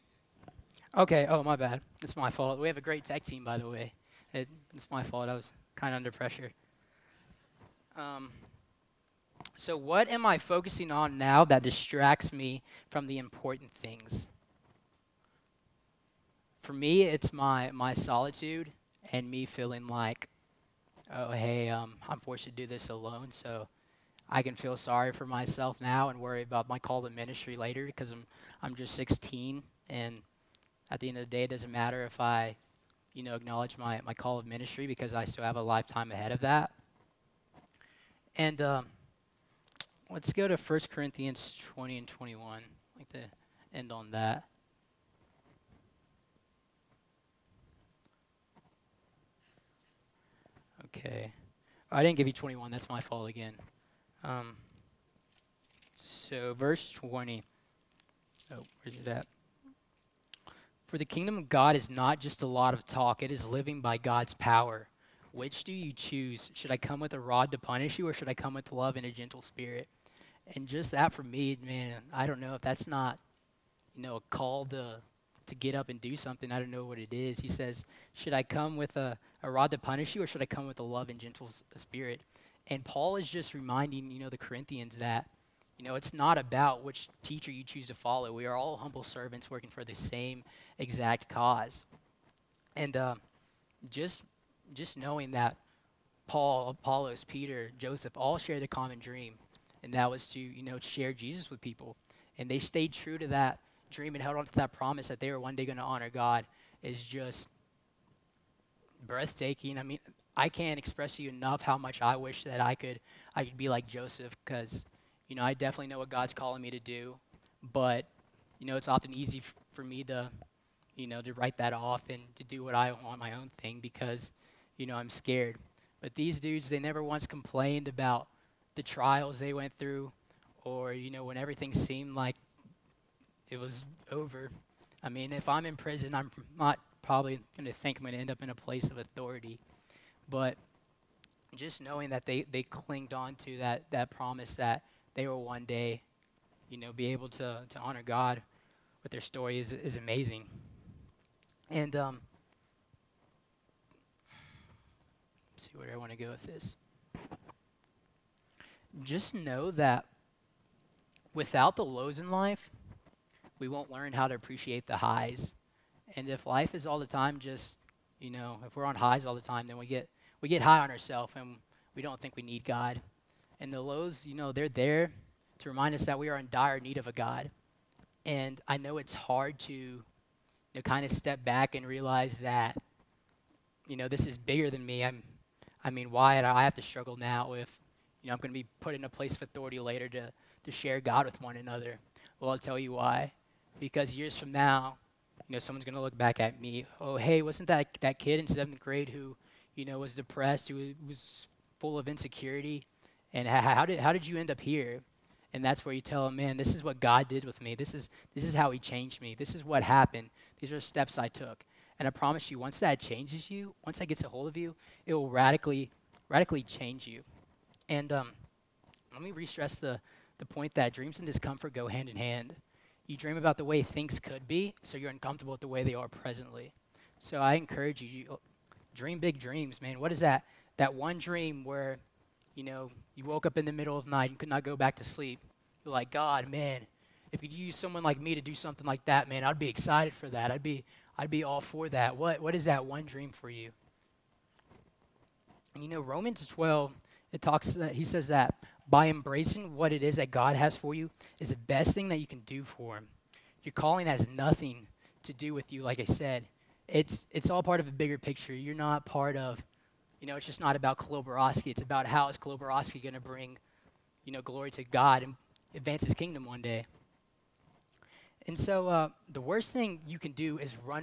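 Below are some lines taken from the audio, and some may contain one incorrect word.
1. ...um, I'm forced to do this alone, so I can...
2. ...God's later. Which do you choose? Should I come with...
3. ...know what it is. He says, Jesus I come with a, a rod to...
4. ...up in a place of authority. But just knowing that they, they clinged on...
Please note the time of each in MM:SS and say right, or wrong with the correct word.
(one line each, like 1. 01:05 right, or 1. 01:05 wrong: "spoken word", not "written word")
1. 00:21 right
2. 01:03 wrong: "power", not "later"
3. 01:16 wrong: "Should", not "Jesus"
4. 02:18 right.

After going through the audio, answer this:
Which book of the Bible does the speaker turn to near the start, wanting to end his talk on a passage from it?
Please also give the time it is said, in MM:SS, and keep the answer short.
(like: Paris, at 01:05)
1 Corinthians, at 00:40.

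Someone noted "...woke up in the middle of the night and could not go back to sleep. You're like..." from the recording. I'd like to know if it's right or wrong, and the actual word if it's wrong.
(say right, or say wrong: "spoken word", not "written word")
right.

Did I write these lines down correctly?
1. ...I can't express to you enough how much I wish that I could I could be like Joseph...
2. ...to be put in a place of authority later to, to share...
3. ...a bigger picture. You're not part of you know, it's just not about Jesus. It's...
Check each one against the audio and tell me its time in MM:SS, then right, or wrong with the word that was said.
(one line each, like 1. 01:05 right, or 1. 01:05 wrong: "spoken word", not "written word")
1. 01:50 right
2. 03:08 right
3. 04:17 wrong: "Koloborowski", not "Jesus".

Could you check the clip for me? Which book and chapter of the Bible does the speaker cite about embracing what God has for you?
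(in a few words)
Romans 12.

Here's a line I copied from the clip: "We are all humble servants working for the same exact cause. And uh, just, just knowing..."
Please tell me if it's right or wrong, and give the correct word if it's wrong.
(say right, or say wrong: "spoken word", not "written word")
right.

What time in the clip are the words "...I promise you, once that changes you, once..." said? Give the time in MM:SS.
03:32.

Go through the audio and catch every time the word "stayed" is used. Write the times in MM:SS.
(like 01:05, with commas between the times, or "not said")
01:42.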